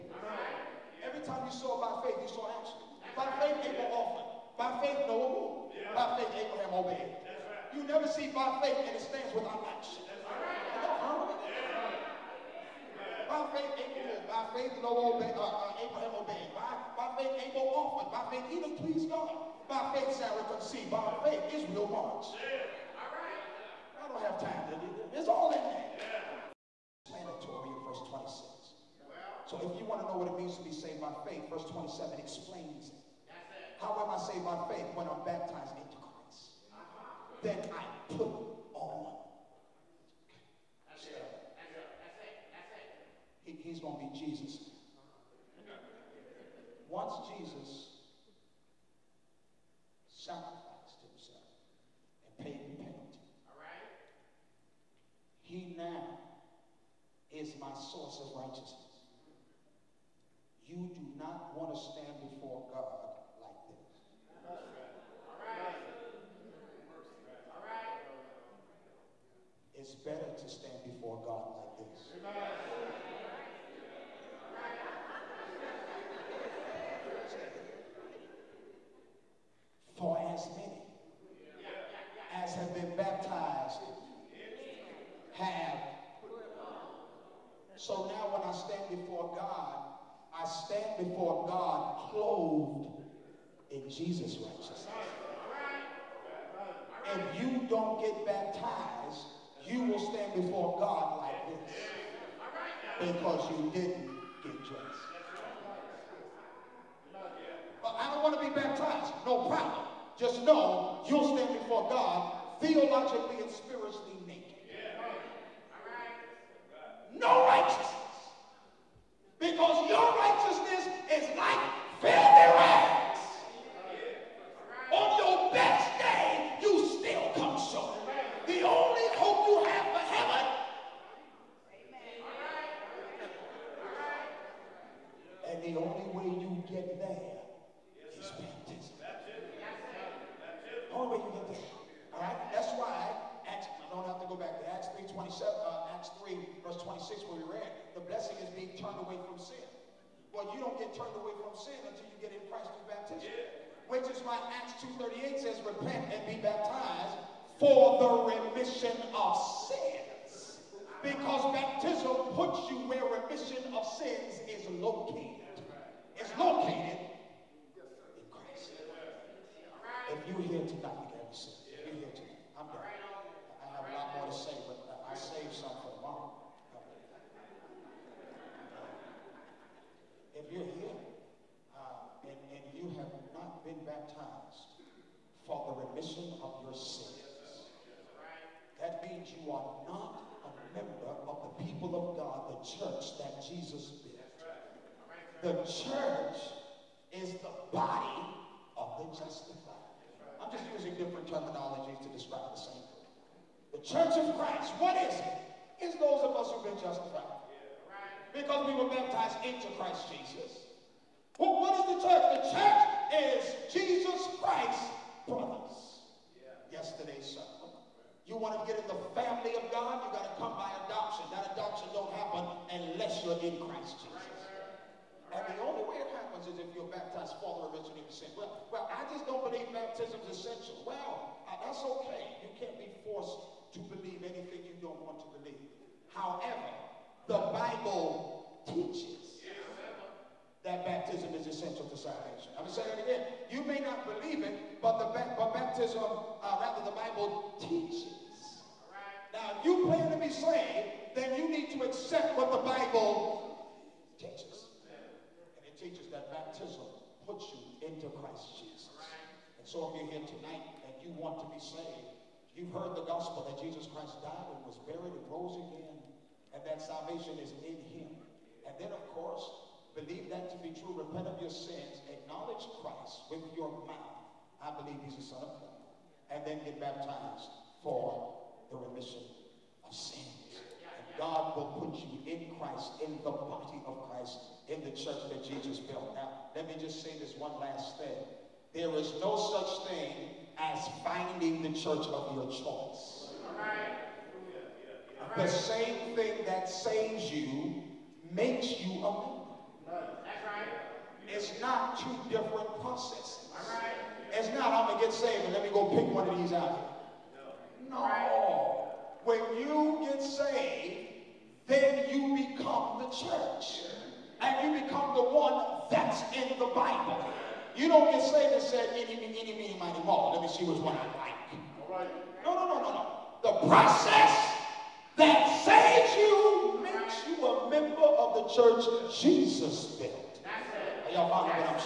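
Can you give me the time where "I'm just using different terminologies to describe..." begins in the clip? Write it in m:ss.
3:20.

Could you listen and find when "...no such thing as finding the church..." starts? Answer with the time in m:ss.
4:49.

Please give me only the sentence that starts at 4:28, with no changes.
And then, of course, believe that to be true, repent of your sins, acknowledge Christ with your mouth.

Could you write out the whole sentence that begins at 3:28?
Because we were baptized into Christ Jesus.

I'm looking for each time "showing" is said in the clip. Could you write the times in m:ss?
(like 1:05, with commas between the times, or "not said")
not said.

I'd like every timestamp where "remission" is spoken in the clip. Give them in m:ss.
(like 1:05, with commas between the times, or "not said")
2:43, 4:38.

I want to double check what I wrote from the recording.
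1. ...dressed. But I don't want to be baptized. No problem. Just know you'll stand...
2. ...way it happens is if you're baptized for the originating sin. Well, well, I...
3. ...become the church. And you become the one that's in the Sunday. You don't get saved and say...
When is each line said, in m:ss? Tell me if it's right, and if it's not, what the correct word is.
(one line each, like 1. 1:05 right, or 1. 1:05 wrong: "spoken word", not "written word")
1. 1:44 right
2. 3:45 right
3. 5:12 wrong: "Bible", not "Sunday".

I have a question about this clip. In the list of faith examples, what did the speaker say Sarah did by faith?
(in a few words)
Conceived.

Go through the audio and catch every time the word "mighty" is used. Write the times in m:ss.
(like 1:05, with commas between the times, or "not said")
5:19.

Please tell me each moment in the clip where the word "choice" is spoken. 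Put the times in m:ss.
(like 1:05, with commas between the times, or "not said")
4:52.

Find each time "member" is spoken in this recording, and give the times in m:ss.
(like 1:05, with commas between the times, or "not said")
4:58, 5:27.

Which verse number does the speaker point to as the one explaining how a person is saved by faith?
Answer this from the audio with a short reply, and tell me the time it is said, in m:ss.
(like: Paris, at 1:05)
27, at 0:31.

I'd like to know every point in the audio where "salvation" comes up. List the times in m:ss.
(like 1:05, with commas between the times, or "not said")
4:01, 4:26.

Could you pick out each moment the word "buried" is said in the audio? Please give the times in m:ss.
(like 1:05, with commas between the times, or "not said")
4:24.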